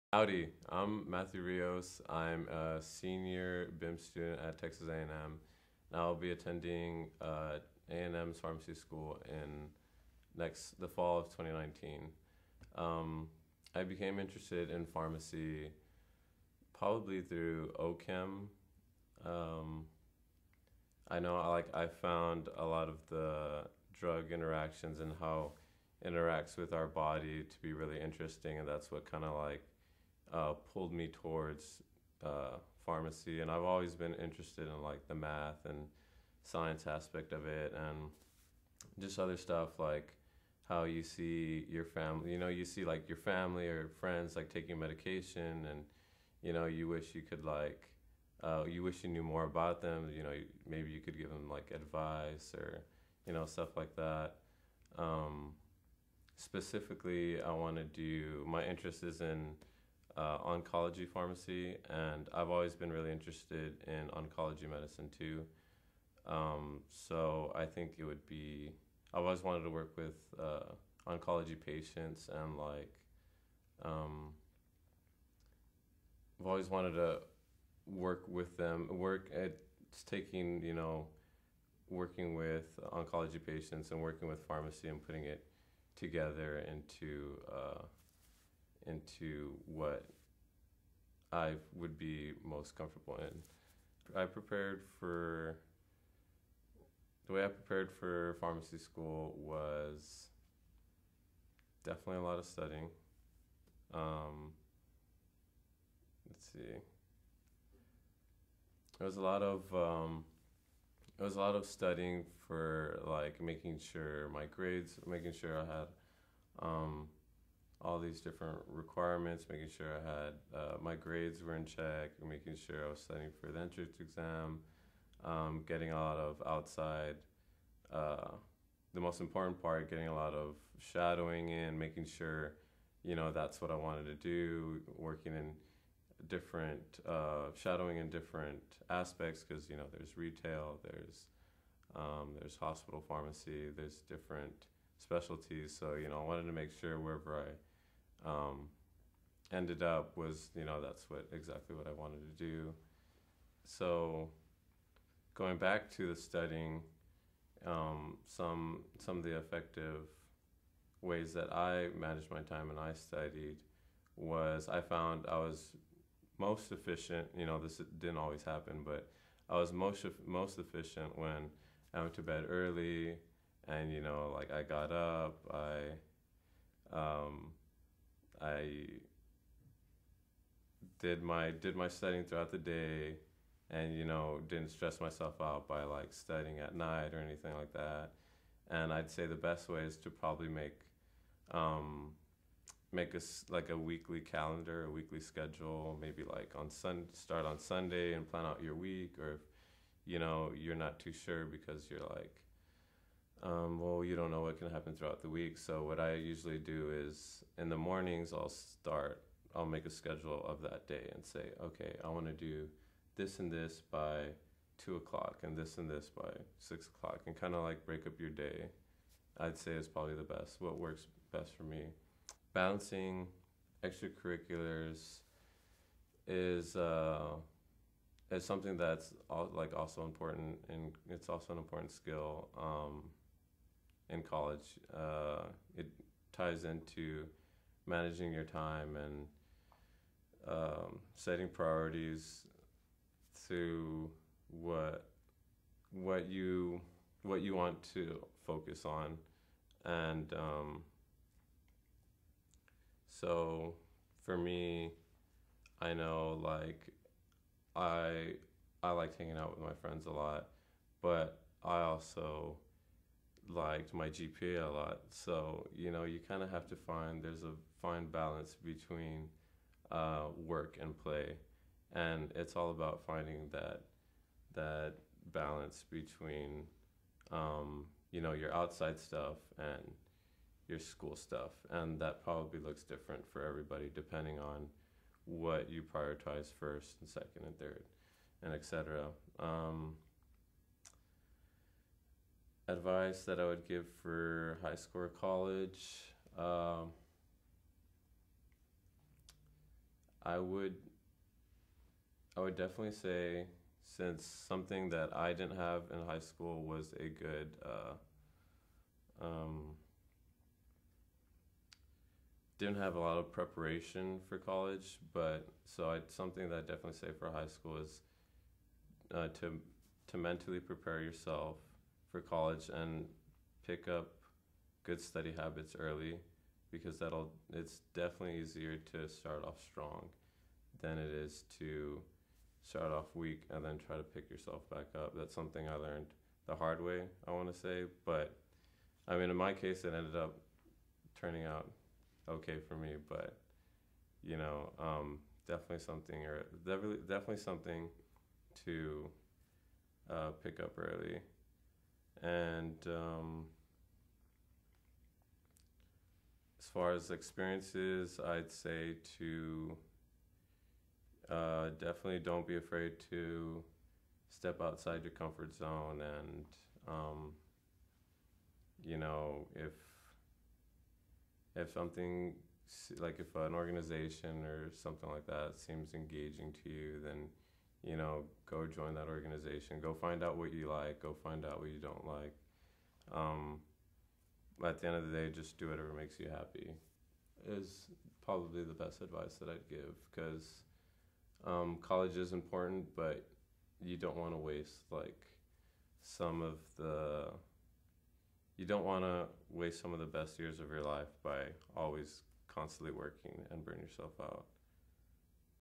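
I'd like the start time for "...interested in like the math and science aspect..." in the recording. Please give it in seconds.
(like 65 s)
34 s.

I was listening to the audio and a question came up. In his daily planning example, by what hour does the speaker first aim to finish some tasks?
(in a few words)
2 o'clock.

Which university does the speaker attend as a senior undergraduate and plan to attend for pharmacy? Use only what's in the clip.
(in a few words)
Texas A&M.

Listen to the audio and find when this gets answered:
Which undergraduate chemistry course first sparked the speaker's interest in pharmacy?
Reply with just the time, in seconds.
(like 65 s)
17 s.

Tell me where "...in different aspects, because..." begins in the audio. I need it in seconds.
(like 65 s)
137 s.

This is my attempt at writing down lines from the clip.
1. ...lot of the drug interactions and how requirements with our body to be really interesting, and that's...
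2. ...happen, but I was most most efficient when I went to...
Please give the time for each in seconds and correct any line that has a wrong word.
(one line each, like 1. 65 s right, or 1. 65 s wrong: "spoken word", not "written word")
1. 22 s wrong: "interacts", not "requirements"
2. 168 s right.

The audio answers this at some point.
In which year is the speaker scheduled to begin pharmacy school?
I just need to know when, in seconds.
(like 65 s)
11 s.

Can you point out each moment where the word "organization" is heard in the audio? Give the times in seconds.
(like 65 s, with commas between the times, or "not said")
373 s, 379 s.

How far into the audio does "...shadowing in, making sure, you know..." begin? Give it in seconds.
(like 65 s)
130 s.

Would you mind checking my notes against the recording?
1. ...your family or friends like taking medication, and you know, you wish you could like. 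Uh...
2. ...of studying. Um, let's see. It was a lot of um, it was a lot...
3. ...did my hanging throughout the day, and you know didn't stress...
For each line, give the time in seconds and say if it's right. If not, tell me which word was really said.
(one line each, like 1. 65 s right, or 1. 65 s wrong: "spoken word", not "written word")
1. 43 s right
2. 102 s right
3. 181 s wrong: "studying", not "hanging".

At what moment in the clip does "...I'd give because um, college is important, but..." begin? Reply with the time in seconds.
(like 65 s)
389 s.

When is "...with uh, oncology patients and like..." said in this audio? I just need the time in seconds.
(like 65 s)
69 s.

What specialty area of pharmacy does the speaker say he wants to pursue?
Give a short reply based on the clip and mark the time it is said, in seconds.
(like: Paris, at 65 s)
Oncology pharmacy, at 60 s.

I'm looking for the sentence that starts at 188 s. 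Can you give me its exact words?
And I'd say the best way is to probably make um, make a like a weekly calendar, a weekly schedule.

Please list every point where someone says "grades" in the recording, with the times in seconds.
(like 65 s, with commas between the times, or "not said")
114 s, 120 s.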